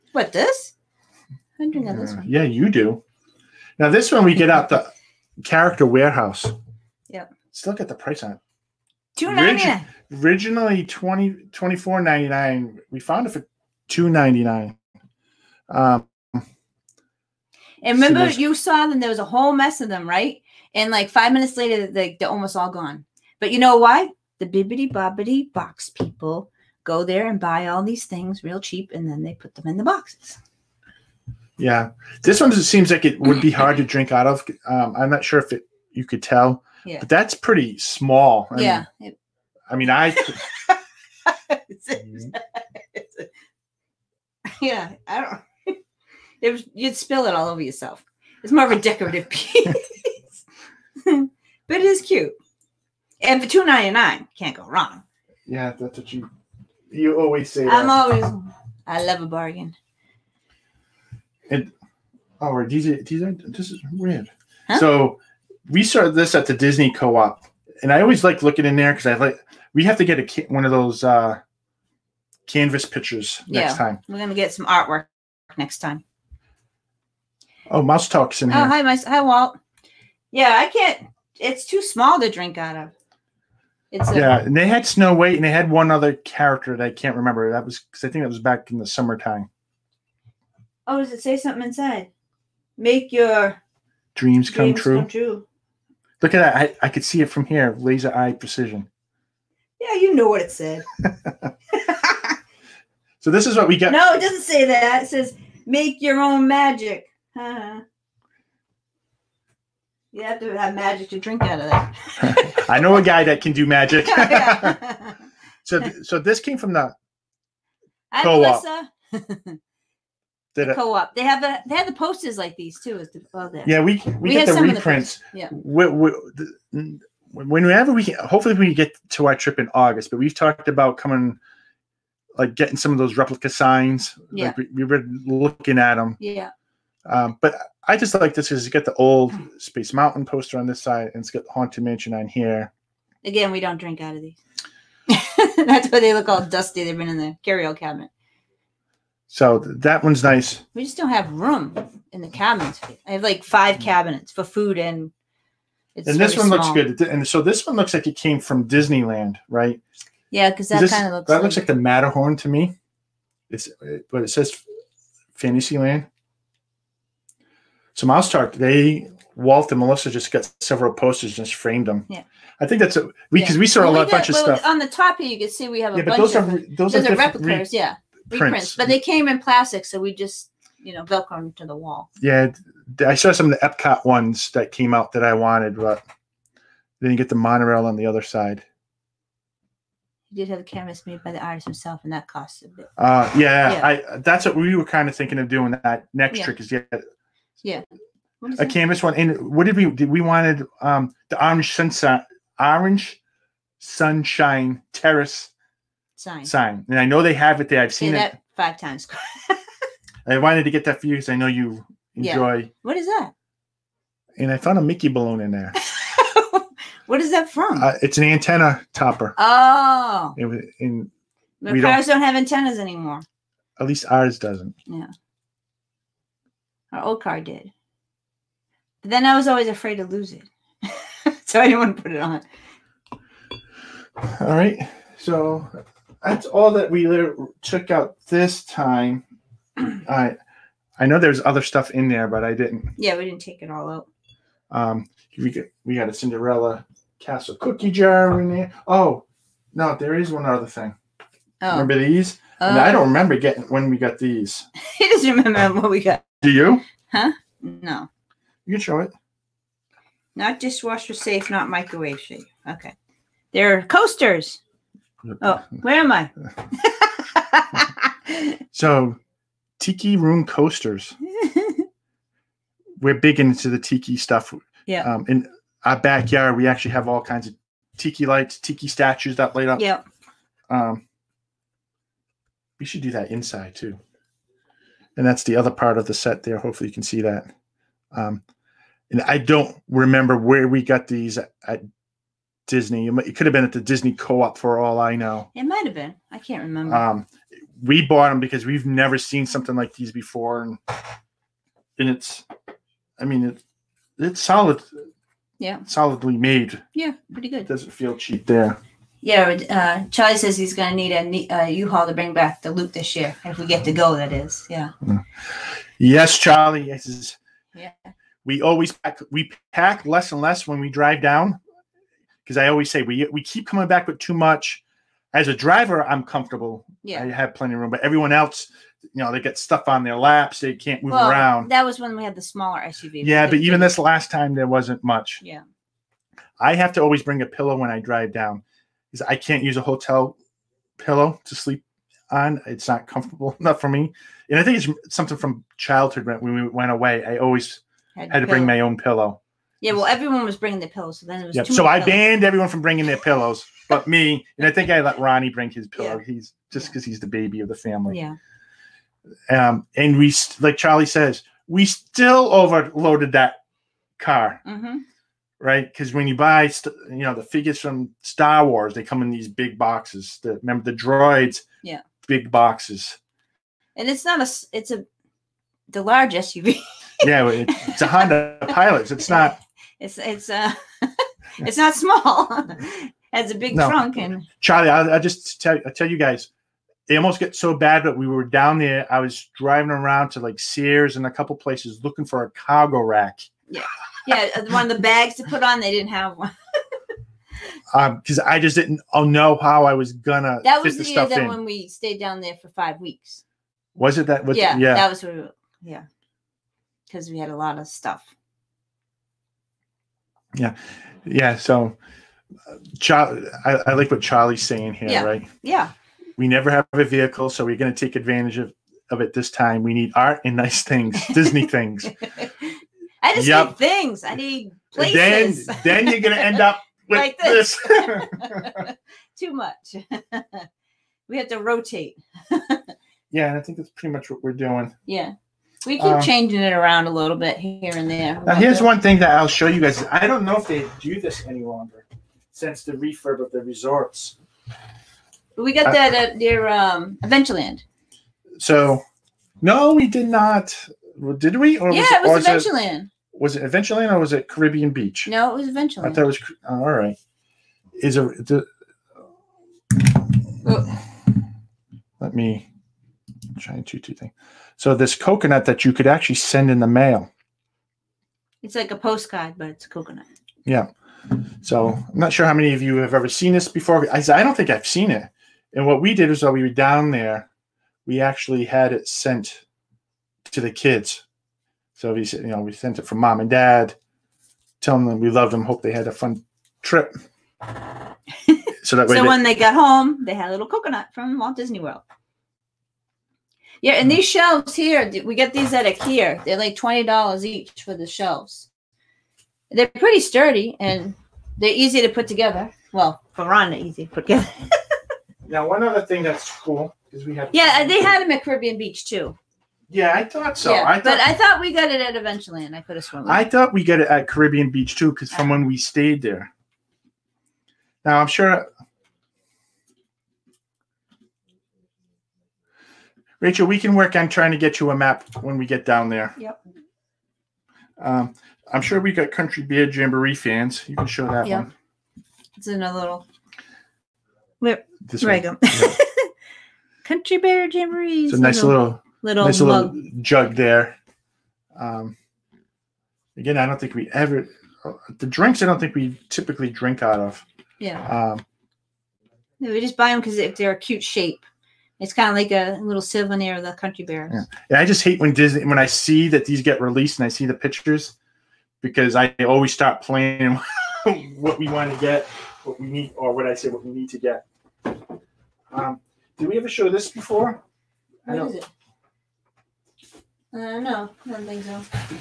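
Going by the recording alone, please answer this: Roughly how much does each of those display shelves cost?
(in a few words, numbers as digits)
$20.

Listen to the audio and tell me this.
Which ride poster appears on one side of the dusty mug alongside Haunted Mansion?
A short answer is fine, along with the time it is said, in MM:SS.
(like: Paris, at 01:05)
Space Mountain, at 02:19.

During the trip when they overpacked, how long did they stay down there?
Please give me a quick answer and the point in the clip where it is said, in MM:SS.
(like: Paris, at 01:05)
Five weeks, at 06:42.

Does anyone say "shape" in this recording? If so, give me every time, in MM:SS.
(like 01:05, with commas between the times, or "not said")
09:11.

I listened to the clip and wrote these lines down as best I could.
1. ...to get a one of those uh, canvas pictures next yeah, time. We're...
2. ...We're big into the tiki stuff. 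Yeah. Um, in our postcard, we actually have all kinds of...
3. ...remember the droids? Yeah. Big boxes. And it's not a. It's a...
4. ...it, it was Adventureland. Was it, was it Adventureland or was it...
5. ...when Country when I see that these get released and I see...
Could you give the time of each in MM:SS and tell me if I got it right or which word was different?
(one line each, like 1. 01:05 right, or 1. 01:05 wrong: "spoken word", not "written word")
1. 01:09 right
2. 04:32 wrong: "backyard", not "postcard"
3. 06:10 right
4. 07:32 right
5. 09:15 wrong: "Disney", not "Country".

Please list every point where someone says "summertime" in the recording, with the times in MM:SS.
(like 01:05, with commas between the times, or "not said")
01:28.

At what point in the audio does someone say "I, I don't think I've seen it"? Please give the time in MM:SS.
07:54.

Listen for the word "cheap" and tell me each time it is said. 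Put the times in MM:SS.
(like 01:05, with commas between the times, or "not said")
00:28, 05:08.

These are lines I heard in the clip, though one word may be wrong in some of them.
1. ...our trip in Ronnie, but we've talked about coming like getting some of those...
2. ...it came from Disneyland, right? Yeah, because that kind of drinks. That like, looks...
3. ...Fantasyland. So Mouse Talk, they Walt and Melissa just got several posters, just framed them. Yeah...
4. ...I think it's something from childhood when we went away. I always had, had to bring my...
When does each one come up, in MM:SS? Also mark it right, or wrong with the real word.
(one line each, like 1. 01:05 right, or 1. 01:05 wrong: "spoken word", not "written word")
1. 02:09 wrong: "August", not "Ronnie"
2. 02:38 wrong: "looks", not "drinks"
3. 02:45 right
4. 05:44 right.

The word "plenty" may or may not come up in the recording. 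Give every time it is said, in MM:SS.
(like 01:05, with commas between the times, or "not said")
05:27.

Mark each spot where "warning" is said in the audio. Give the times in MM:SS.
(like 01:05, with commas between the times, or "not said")
not said.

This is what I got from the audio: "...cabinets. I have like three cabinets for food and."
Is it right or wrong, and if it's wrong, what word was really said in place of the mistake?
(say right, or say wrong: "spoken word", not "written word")
wrong: "five", not "three".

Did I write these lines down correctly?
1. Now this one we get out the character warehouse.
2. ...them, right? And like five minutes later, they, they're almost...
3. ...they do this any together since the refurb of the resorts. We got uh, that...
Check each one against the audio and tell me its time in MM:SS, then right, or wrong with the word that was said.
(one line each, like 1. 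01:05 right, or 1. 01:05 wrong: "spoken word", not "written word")
1. 00:03 right
2. 00:19 right
3. 07:20 wrong: "longer", not "together".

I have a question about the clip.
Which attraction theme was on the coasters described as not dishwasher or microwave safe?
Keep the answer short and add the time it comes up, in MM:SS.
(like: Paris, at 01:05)
Tiki room, at 04:29.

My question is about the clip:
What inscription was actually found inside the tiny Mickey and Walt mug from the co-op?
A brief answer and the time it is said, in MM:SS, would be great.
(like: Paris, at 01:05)
Make your own magic, at 01:45.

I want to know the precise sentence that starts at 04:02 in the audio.
Yeah, we didn't take it all out.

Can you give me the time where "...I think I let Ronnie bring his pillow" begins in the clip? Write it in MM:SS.
05:54.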